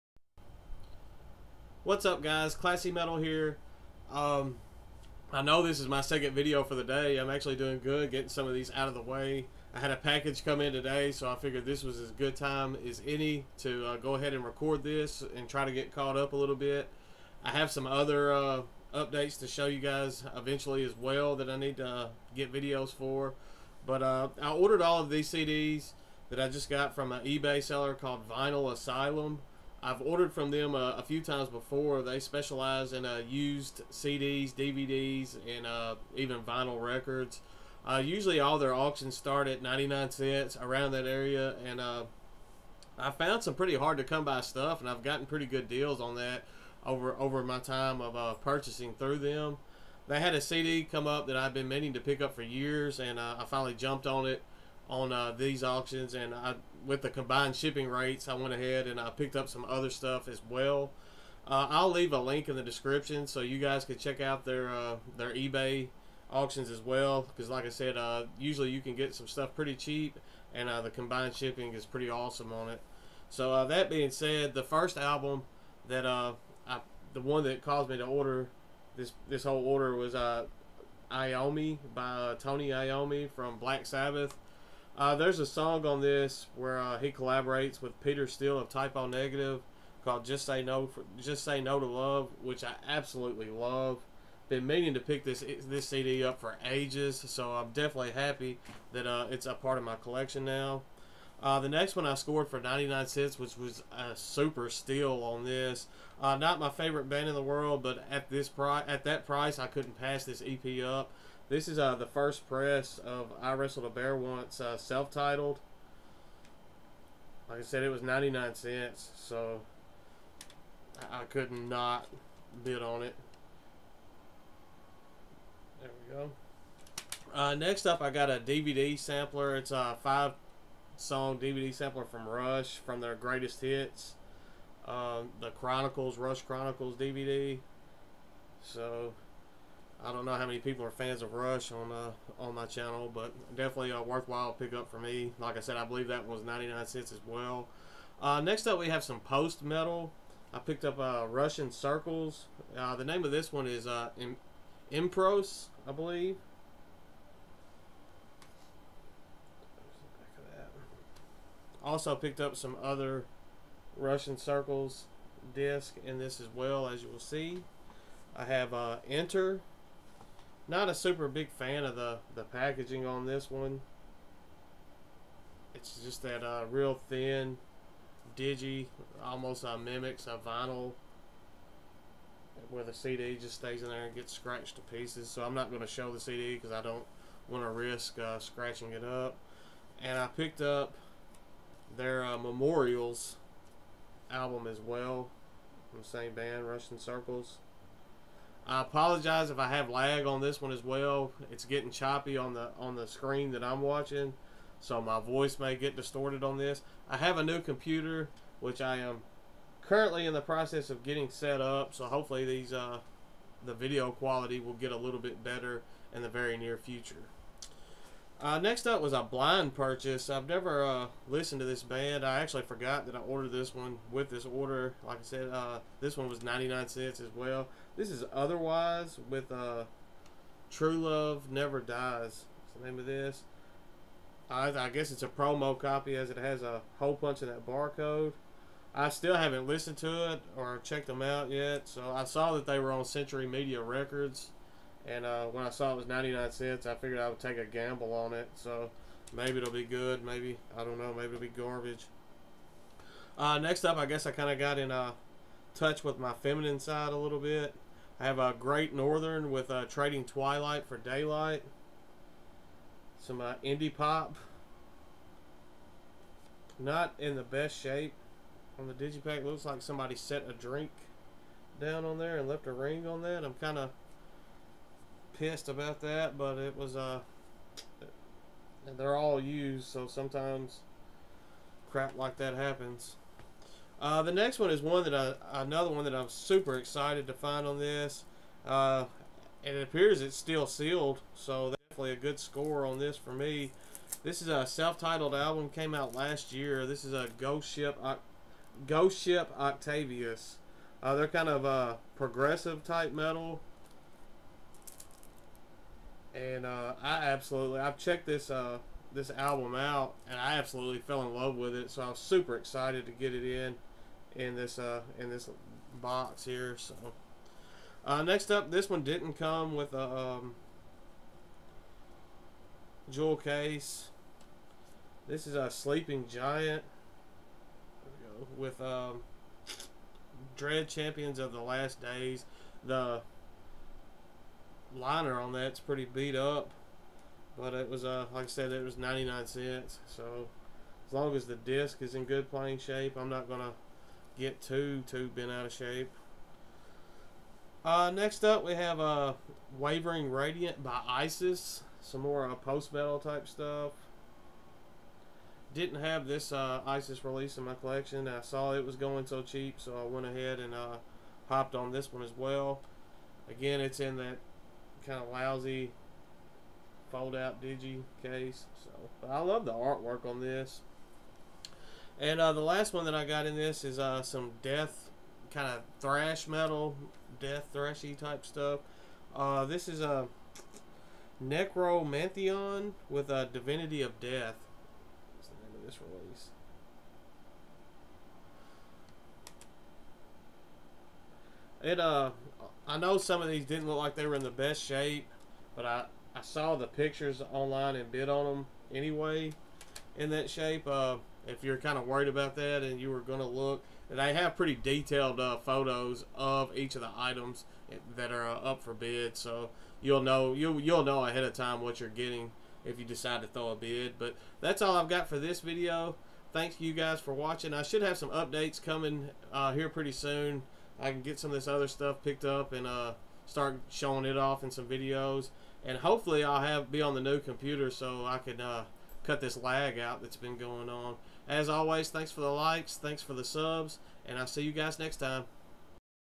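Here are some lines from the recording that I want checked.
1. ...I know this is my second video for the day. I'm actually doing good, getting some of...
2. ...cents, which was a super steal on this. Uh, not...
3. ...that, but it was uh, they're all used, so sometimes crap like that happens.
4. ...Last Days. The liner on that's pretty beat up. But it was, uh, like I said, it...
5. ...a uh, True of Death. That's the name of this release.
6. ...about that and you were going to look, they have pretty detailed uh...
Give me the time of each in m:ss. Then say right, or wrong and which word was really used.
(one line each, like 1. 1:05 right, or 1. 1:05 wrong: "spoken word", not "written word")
1. 0:05 right
2. 1:43 right
3. 4:36 right
4. 5:31 right
5. 6:23 wrong: "Divinity", not "True"
6. 6:42 right.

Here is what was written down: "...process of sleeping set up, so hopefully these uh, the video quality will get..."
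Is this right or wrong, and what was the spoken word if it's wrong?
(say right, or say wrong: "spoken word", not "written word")
wrong: "getting", not "sleeping".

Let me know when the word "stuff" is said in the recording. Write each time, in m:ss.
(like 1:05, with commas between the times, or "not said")
0:44, 0:59, 1:09, 5:53, 6:18, 7:01.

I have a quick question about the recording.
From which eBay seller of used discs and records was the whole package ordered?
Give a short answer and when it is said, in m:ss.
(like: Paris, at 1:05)
Vinyl Asylum, at 0:28.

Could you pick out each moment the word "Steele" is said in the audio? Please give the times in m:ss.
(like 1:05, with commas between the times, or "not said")
1:28.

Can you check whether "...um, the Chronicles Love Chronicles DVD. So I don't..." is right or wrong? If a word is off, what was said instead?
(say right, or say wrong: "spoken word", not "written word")
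wrong: "Rush", not "Love".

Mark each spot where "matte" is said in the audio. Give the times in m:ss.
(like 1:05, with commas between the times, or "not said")
not said.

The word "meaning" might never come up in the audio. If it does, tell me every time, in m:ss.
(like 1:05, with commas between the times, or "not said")
0:51, 1:34.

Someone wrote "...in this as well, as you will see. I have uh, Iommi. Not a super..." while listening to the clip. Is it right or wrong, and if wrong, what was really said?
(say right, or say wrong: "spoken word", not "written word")
wrong: "Enter", not "Iommi".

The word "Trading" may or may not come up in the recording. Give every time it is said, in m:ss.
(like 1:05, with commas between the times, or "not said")
4:19.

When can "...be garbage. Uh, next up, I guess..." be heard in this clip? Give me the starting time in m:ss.
4:11.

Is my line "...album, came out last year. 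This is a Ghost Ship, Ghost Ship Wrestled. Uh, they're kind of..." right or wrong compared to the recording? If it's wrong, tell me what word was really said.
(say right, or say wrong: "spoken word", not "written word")
wrong: "Octavius", not "Wrestled".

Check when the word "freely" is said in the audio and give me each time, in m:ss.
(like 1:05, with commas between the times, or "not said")
not said.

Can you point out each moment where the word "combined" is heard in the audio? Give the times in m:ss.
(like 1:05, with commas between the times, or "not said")
0:57, 1:10.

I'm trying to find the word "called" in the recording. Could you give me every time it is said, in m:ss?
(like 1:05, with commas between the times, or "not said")
0:27, 1:30.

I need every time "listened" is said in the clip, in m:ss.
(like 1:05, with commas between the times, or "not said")
3:41, 3:59.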